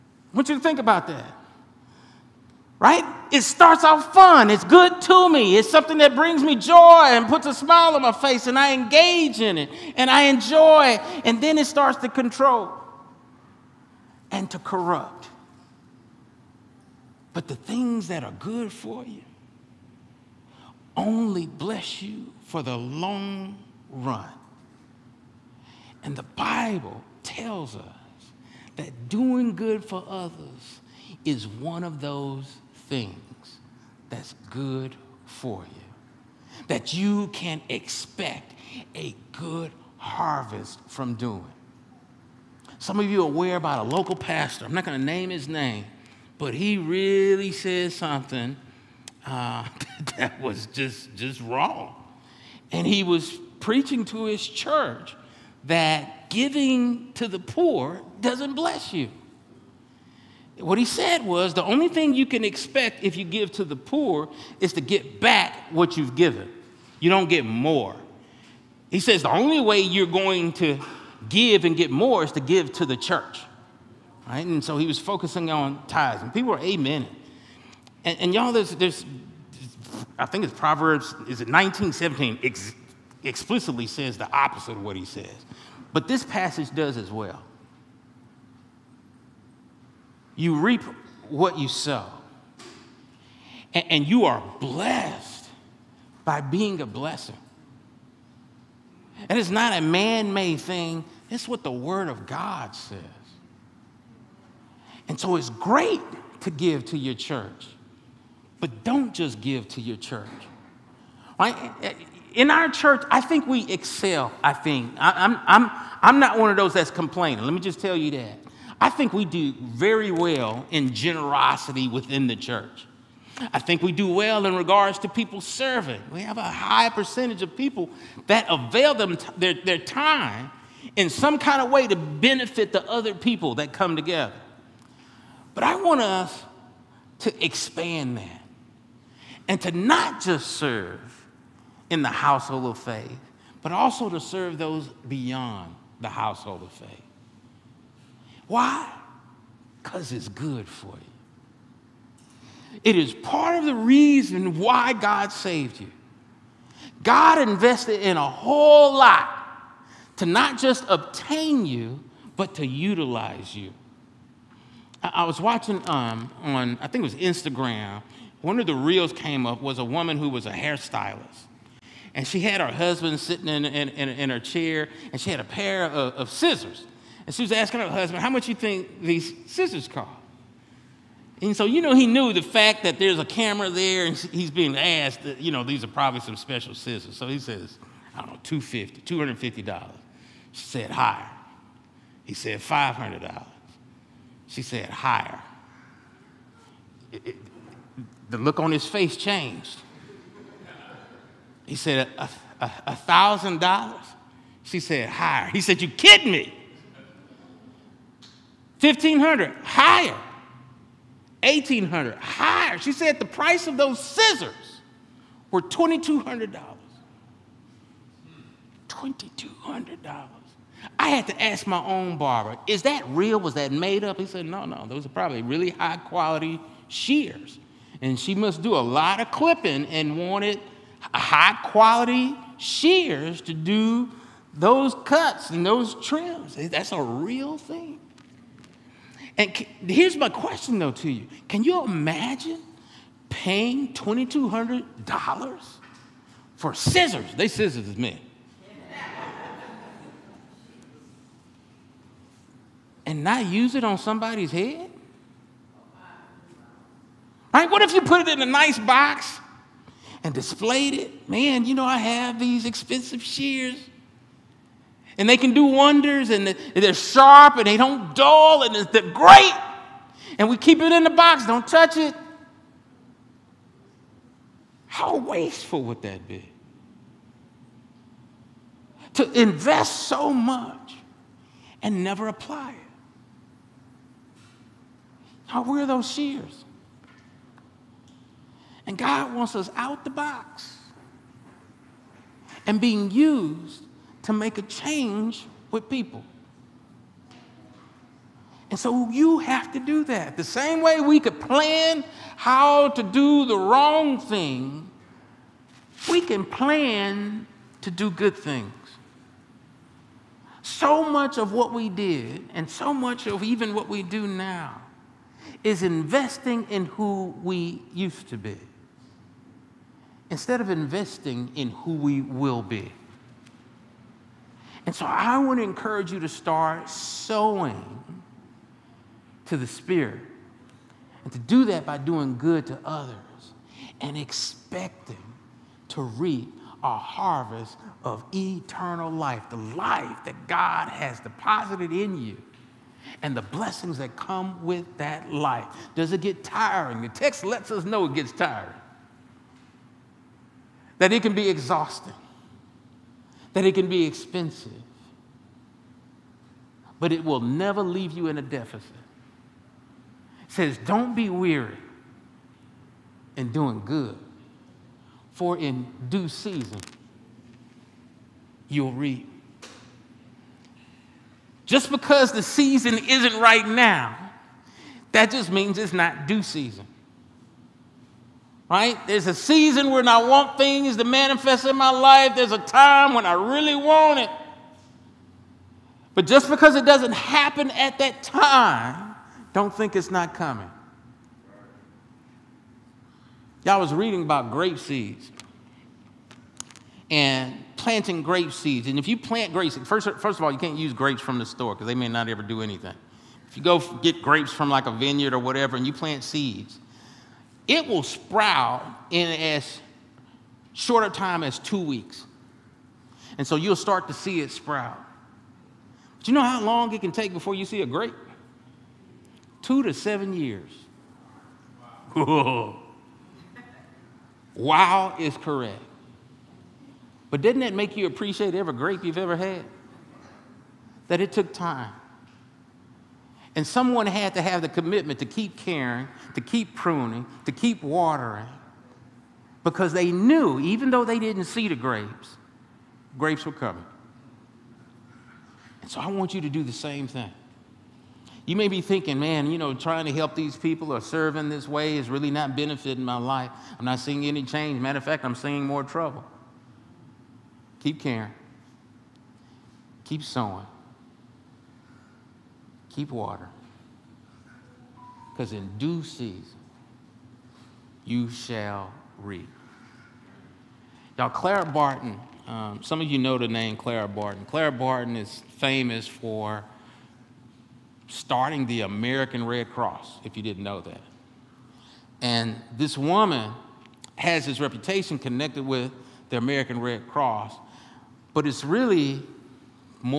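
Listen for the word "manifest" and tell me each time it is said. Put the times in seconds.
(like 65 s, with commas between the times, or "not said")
381 s.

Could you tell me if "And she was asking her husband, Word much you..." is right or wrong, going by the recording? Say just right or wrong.
wrong.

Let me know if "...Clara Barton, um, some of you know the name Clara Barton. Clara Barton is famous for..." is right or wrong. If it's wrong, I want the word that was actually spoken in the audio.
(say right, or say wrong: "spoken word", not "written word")
right.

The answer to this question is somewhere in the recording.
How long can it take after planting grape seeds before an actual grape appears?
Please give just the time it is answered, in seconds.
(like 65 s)
419 s.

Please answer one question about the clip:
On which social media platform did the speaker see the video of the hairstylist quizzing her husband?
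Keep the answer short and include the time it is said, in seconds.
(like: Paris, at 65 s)
Instagram, at 167 s.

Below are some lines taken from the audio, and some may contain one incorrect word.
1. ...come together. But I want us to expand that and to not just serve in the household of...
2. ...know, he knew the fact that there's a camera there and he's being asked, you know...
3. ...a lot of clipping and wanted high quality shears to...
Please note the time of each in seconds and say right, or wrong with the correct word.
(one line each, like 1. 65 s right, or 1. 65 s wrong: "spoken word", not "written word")
1. 133 s right
2. 181 s right
3. 228 s right.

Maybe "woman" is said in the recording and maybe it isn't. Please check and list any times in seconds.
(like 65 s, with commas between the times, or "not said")
169 s, 482 s.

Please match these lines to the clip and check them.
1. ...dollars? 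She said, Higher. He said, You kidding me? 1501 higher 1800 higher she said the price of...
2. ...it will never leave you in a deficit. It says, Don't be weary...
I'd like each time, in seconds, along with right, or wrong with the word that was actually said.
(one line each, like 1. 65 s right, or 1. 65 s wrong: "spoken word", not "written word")
1. 203 s wrong: "1500", not "1501"
2. 357 s right.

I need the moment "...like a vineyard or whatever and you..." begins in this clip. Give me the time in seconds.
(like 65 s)
404 s.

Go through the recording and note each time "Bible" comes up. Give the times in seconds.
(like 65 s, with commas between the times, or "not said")
26 s.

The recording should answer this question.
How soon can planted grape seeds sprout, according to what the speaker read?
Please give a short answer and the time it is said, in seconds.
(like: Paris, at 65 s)
2 weeks, at 411 s.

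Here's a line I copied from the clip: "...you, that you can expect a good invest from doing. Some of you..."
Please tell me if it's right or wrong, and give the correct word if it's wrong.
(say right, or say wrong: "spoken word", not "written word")
wrong: "harvest", not "invest".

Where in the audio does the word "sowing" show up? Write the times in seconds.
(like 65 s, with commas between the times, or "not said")
326 s, 460 s.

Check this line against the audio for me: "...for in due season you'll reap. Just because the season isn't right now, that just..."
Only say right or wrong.
right.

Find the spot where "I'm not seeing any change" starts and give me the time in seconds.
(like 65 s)
453 s.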